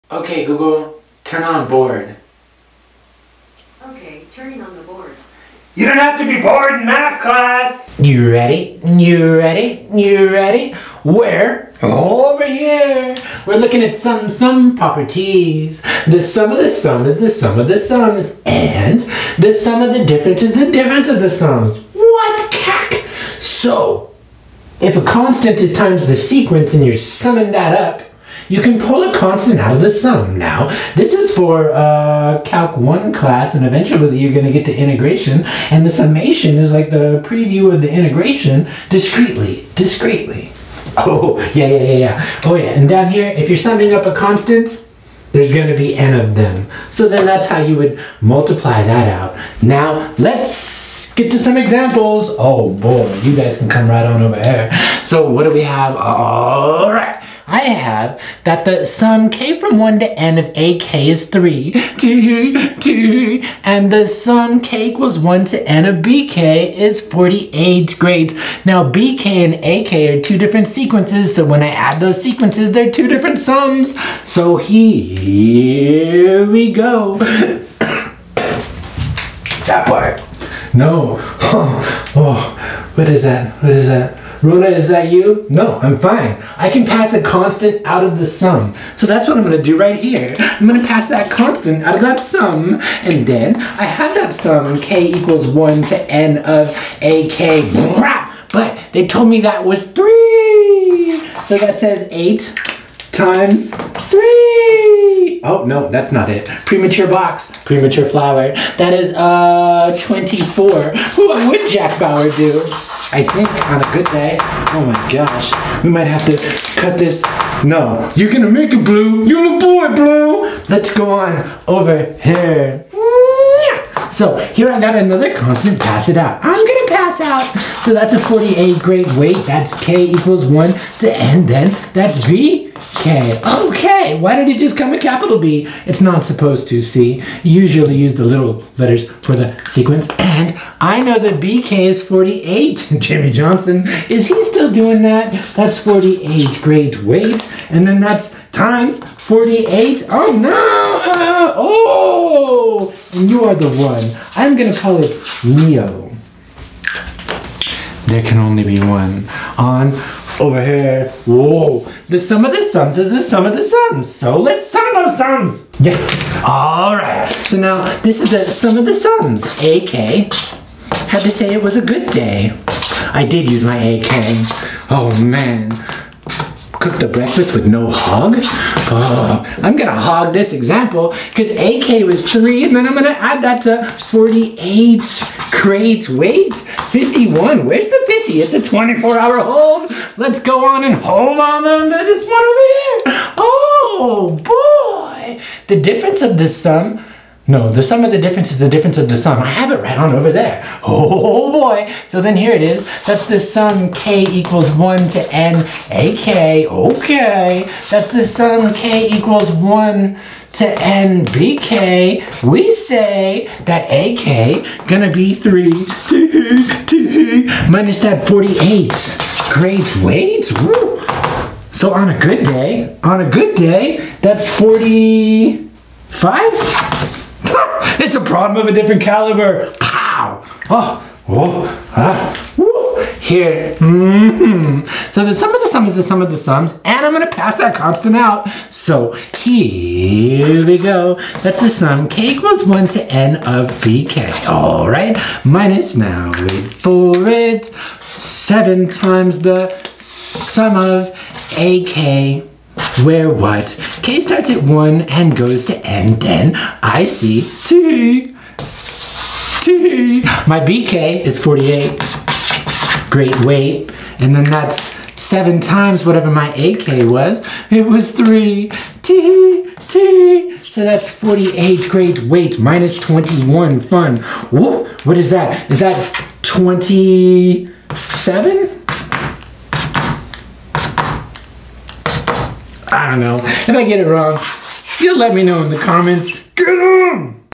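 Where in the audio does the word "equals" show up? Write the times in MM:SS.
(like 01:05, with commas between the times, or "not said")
01:04, 01:35, 02:10, 03:24, 03:29, 04:02.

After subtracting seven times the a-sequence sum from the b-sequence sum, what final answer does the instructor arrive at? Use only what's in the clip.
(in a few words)
27.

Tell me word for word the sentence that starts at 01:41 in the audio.
So that says 8 times three.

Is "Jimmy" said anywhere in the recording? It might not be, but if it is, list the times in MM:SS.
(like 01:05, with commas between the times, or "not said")
02:22.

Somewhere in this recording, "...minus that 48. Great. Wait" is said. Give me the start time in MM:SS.
03:37.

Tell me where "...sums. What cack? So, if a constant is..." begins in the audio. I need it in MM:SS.
00:21.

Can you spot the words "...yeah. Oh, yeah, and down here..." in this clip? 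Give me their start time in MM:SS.
00:41.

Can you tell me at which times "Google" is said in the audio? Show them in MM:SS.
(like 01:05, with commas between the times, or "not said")
00:00.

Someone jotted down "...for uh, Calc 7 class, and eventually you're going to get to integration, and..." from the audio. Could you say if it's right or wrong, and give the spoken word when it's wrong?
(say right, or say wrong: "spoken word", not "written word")
wrong: "1", not "7".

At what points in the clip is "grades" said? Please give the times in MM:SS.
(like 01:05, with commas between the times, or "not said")
01:07, 02:08.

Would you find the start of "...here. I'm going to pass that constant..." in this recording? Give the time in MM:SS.
01:29.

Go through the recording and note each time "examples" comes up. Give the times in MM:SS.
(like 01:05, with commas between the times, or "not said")
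00:51, 03:00.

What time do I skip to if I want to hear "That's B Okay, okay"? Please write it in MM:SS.
02:11.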